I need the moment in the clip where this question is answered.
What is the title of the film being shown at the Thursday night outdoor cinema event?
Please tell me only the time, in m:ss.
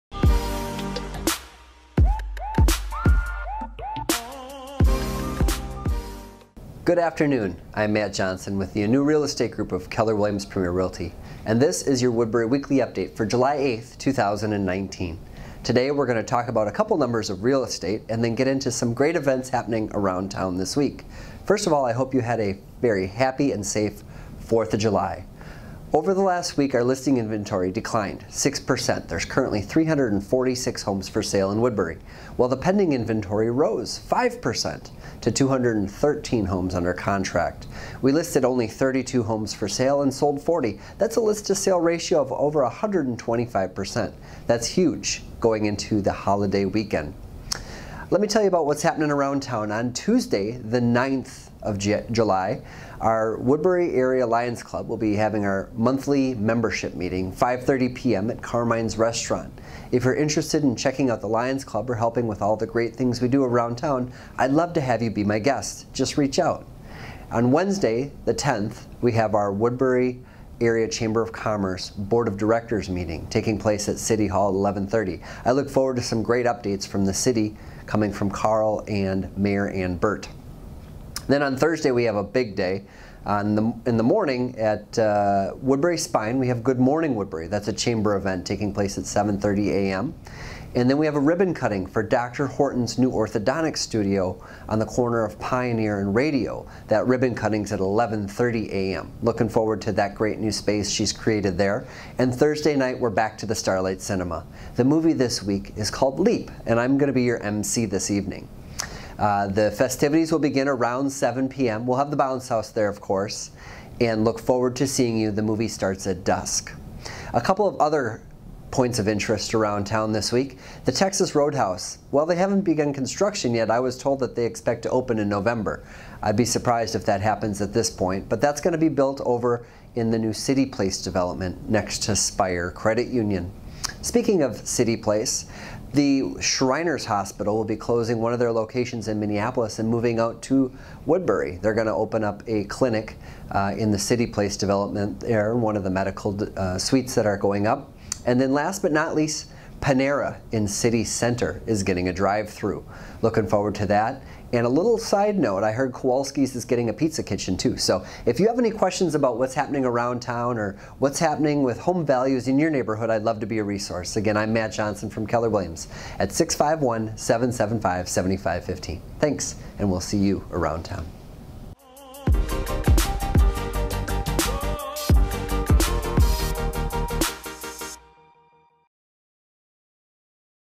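1:46.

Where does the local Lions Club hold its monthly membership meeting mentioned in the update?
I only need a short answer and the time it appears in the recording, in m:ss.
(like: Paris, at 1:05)
Carmine's Restaurant, at 0:58.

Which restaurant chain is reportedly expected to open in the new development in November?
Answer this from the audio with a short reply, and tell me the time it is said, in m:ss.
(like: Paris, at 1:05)
Texas Roadhouse, at 2:00.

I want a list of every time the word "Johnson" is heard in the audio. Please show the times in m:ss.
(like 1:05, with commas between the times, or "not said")
0:08, 2:44.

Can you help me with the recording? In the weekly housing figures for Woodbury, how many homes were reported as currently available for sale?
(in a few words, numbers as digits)
346.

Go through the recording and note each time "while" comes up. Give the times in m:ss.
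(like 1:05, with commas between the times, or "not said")
0:32, 2:02.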